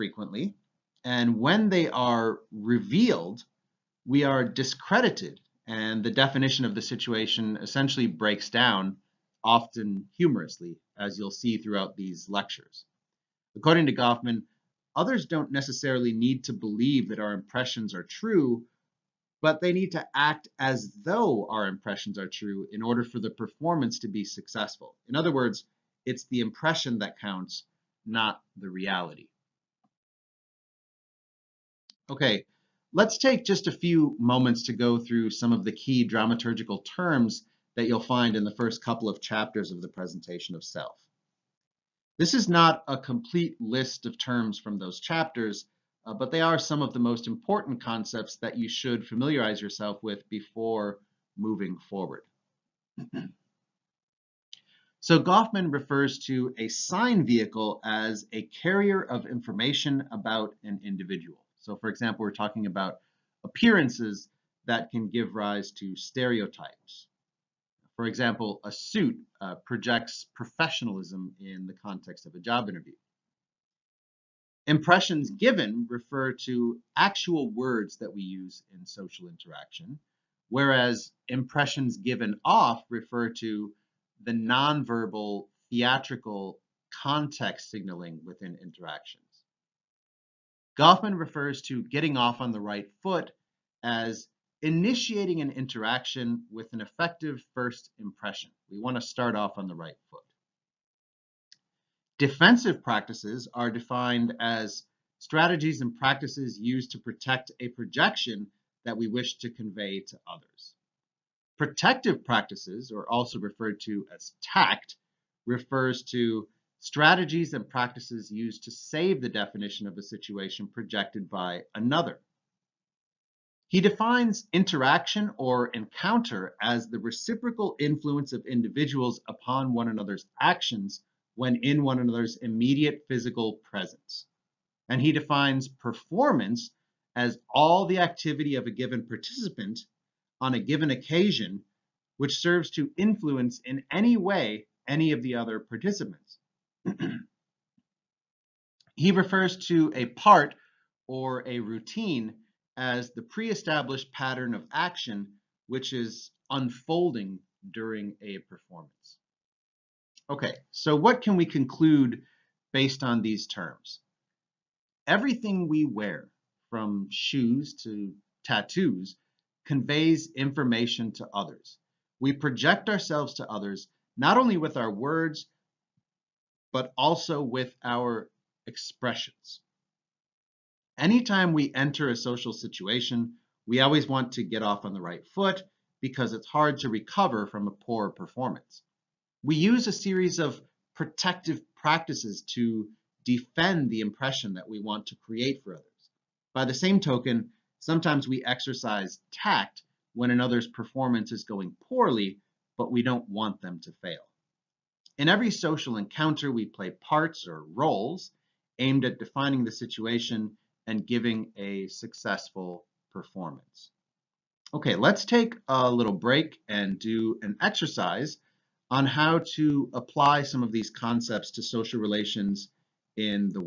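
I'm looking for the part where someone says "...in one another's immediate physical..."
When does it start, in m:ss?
2:11.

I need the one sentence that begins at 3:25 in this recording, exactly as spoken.
In every social encounter, we play parts or roles aimed at defining the situation and giving a successful performance.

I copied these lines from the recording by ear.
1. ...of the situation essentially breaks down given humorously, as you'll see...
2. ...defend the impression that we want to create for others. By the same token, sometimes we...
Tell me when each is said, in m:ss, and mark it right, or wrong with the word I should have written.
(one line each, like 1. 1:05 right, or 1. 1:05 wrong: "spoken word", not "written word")
1. 0:06 wrong: "often", not "given"
2. 3:13 right.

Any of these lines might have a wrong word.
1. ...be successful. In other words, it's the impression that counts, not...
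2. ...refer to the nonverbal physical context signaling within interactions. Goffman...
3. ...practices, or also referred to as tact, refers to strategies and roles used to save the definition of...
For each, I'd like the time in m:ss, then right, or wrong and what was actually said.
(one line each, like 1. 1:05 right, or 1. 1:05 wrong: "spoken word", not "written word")
1. 0:24 right
2. 1:22 wrong: "theatrical", not "physical"
3. 1:52 wrong: "practices", not "roles".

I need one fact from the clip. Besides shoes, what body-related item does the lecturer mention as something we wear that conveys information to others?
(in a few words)
Tattoos.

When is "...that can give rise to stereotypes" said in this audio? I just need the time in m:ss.
1:04.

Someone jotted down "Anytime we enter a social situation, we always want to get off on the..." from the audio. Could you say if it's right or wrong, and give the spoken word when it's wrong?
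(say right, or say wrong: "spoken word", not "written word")
right.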